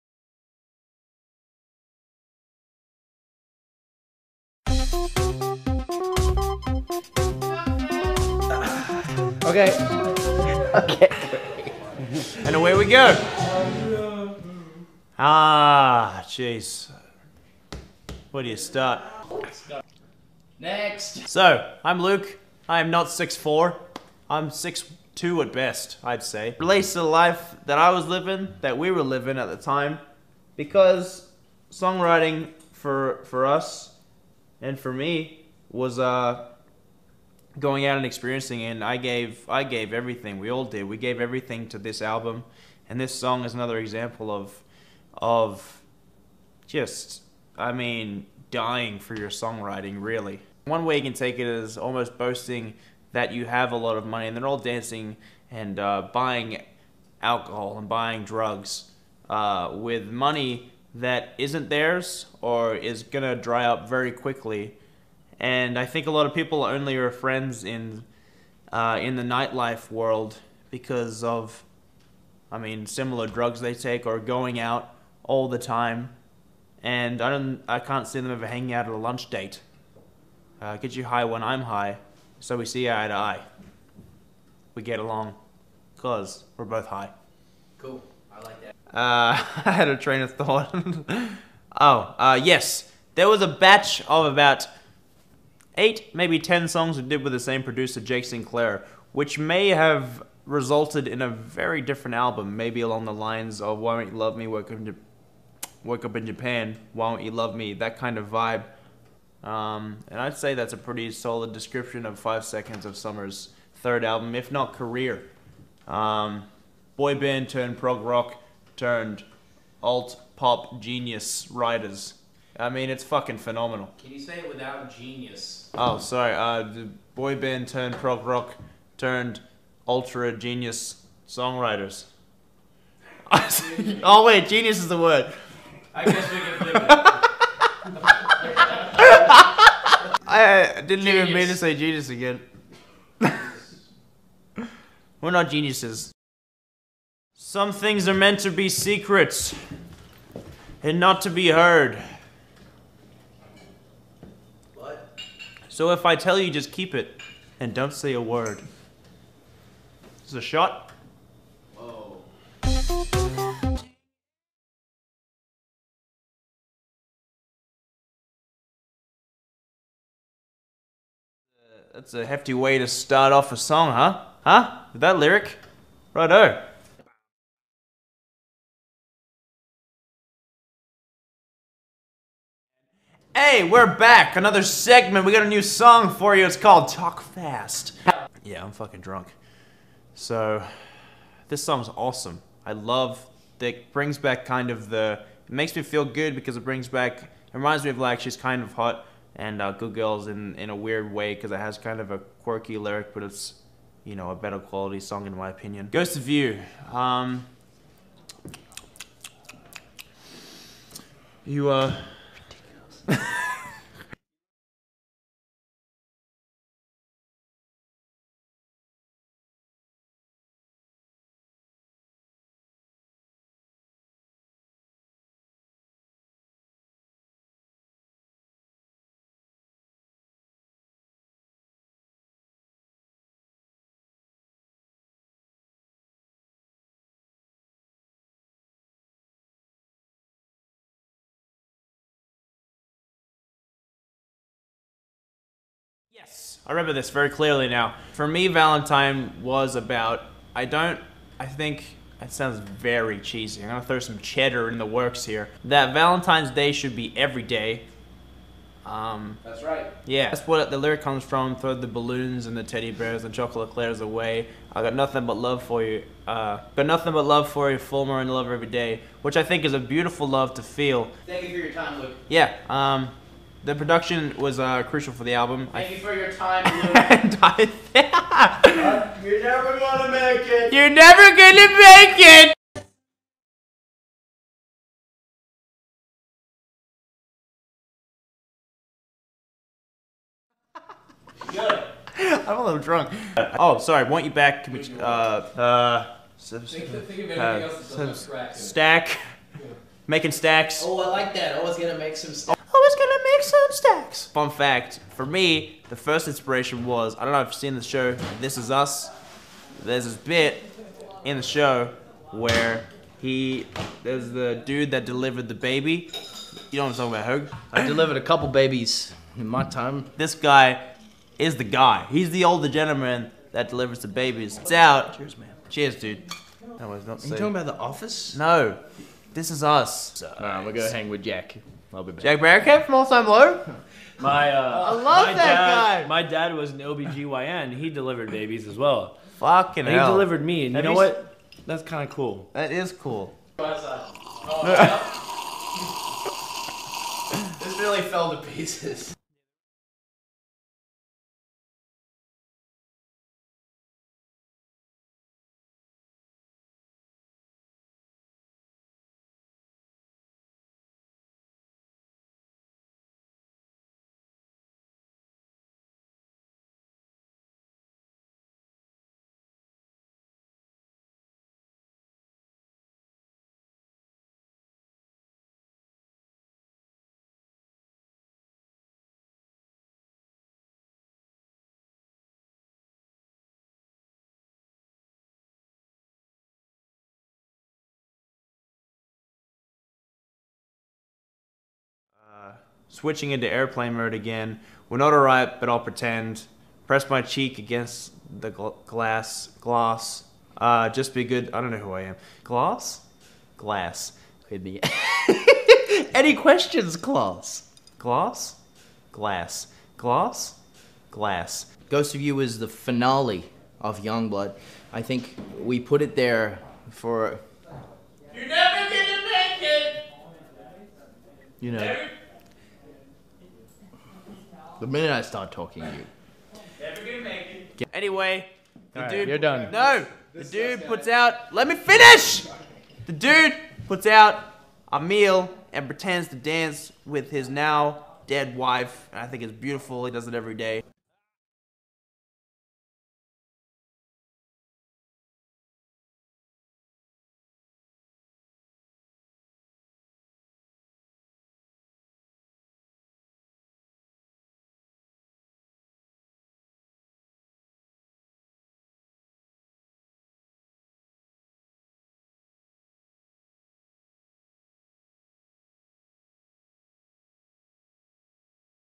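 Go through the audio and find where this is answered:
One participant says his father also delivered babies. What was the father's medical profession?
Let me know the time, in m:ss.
5:36.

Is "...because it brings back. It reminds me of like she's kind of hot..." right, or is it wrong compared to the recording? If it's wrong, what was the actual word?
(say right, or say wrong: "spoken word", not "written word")
right.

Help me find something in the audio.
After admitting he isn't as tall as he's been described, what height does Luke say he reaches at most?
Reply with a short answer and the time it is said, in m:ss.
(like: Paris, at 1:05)
6'2", at 0:24.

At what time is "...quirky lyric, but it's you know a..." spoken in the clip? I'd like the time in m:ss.
3:22.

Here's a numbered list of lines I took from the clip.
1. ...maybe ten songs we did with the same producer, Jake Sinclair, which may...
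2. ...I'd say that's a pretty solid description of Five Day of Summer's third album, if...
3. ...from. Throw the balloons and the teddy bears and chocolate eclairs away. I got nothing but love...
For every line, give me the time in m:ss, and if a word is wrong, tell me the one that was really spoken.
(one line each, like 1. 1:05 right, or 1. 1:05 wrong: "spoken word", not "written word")
1. 1:36 right
2. 1:50 wrong: "Seconds", not "Day"
3. 4:21 right.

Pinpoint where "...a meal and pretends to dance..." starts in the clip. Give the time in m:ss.
7:14.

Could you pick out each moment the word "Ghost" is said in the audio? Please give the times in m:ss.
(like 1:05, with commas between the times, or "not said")
3:25, 6:51.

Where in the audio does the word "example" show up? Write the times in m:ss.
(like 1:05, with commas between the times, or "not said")
0:43.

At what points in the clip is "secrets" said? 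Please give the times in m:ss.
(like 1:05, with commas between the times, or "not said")
2:28.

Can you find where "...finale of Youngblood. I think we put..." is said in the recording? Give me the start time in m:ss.
6:52.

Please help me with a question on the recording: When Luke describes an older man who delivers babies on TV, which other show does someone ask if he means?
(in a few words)
The Office.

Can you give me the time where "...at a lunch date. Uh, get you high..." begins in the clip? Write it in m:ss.
1:18.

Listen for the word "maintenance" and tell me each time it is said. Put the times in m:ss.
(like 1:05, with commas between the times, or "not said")
not said.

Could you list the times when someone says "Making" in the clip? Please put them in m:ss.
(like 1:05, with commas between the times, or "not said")
5:00.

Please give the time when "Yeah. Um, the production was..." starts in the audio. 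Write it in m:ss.
4:32.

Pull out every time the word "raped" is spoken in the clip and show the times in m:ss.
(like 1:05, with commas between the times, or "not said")
not said.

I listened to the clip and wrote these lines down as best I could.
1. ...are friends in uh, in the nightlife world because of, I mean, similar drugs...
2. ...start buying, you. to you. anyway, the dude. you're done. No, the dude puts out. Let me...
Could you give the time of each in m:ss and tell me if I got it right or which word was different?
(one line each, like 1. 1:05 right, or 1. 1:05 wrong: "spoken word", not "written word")
1. 1:06 right
2. 7:05 wrong: "talking", not "buying".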